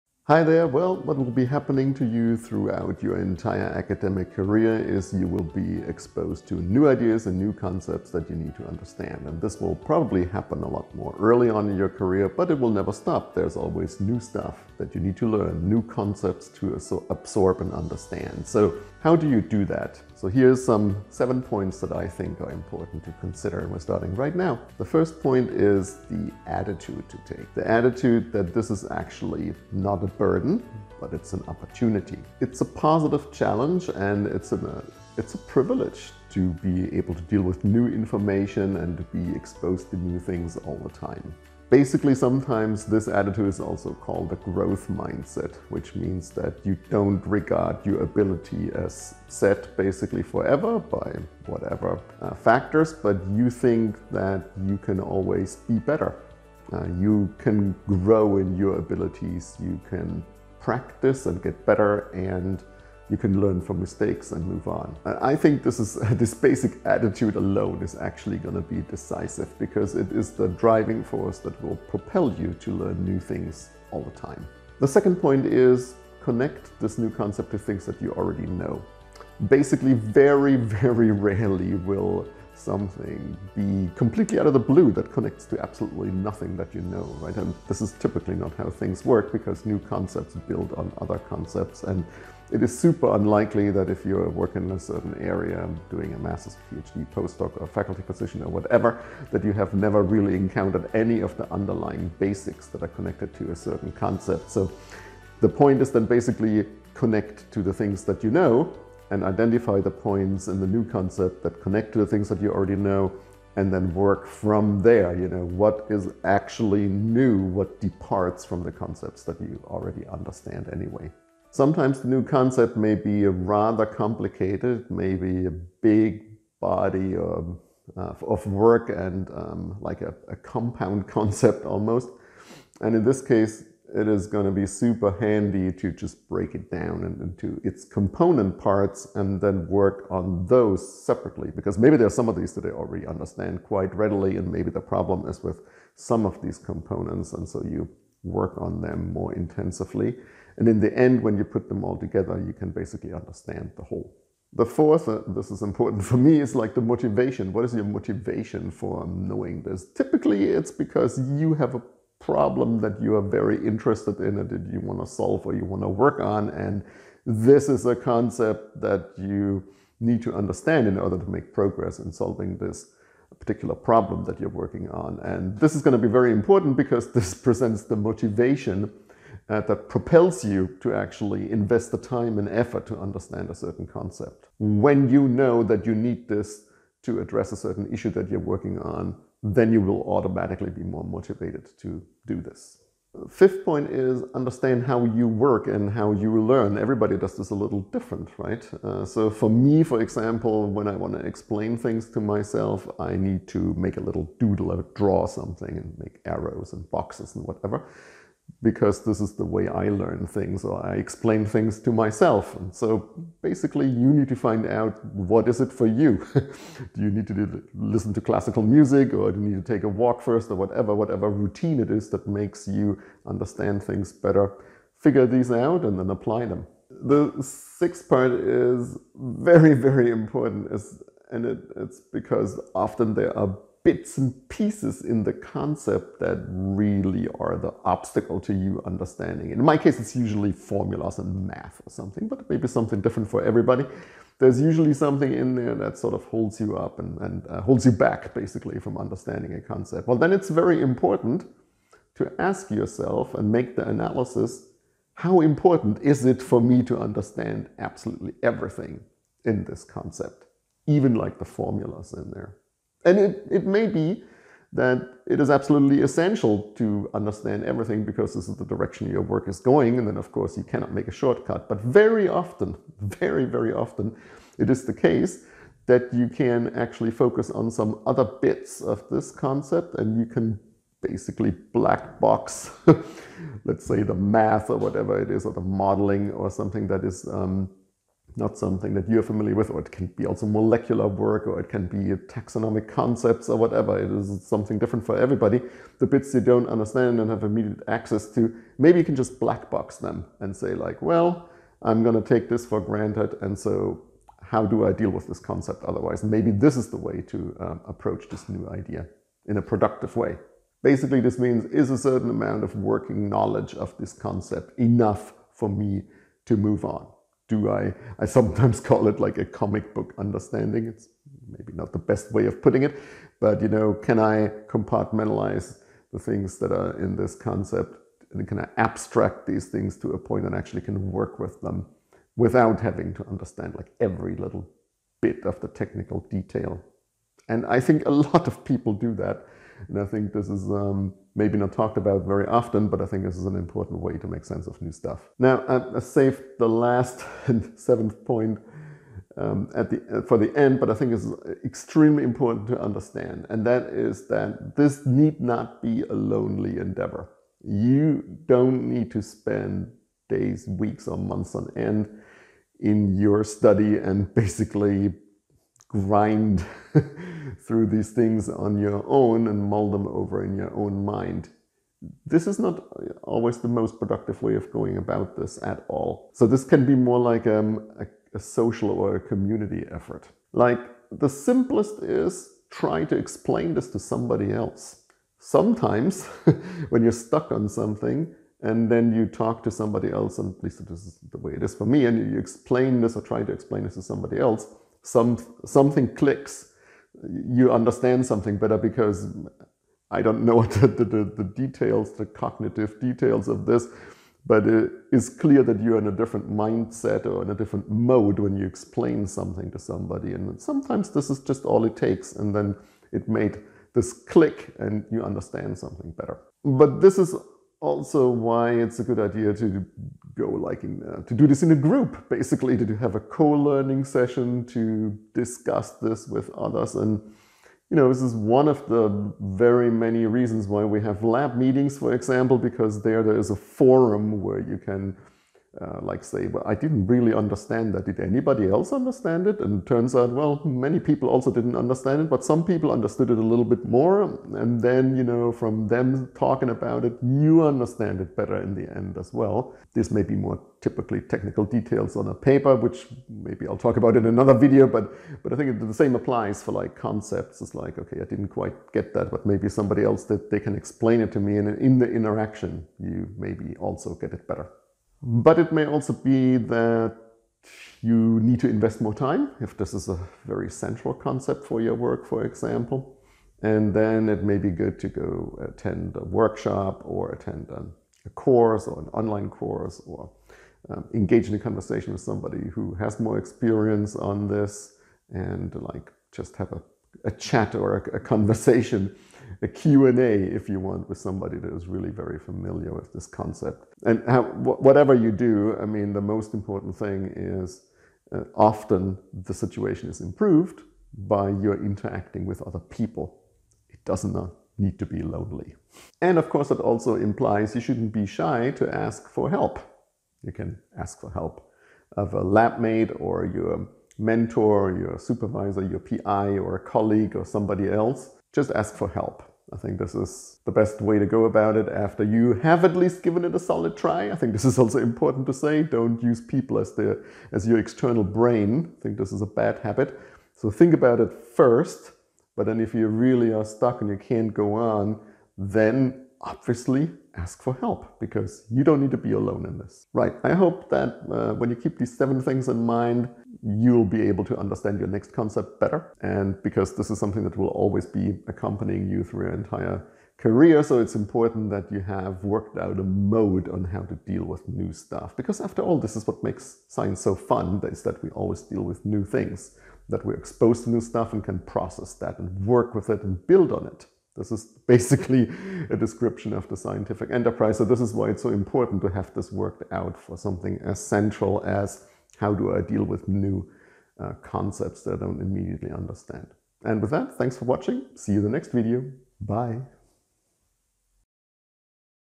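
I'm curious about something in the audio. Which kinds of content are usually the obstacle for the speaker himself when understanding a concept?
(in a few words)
formulas and math.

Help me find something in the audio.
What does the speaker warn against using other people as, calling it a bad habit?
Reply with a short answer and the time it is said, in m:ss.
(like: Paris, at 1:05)
your external brain, at 8:47.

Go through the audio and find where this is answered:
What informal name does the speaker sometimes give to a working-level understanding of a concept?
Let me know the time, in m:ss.
5:19.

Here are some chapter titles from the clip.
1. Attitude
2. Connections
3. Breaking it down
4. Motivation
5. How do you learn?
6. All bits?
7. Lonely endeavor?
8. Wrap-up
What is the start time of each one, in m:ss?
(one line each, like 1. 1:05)
1. 0:25
2. 1:14
3. 2:01
4. 2:34
5. 3:13
6. 3:47
7. 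5:45
8. 9:00.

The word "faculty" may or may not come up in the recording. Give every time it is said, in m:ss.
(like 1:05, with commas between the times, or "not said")
1:37.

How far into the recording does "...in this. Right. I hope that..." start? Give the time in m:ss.
8:59.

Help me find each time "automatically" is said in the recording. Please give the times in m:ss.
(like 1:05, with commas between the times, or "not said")
3:10.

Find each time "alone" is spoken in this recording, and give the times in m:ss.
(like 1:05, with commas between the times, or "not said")
1:07, 8:59.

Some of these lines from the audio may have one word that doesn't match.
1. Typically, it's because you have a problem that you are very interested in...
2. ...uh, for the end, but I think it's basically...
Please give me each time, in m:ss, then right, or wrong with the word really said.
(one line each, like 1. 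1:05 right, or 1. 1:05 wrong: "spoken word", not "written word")
1. 2:39 right
2. 5:50 wrong: "extremely", not "basically".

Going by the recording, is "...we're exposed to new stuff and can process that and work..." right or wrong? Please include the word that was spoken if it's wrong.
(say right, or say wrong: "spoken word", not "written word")
right.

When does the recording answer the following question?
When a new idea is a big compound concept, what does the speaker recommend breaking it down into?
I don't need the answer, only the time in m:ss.
2:17.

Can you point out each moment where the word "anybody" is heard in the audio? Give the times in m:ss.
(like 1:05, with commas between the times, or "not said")
7:18.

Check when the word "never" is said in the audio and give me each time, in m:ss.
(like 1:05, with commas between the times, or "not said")
0:12, 1:39.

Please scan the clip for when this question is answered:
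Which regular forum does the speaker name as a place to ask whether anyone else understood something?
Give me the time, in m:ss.
7:11.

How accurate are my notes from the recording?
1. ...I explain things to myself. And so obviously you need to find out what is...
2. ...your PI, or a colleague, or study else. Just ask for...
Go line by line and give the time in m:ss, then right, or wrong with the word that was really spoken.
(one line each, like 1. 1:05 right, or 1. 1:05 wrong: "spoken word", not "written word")
1. 3:30 wrong: "basically", not "obviously"
2. 8:35 wrong: "somebody", not "study".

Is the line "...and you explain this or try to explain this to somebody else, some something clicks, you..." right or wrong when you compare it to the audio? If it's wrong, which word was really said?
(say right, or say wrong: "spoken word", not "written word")
right.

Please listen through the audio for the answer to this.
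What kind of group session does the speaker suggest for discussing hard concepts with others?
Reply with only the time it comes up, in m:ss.
7:03.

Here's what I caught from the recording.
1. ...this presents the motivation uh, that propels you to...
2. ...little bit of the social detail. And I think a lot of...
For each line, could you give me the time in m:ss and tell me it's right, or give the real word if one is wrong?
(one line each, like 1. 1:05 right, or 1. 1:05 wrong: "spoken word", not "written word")
1. 2:57 right
2. 5:34 wrong: "technical", not "social".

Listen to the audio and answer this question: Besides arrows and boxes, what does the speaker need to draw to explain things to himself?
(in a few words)
a little doodle.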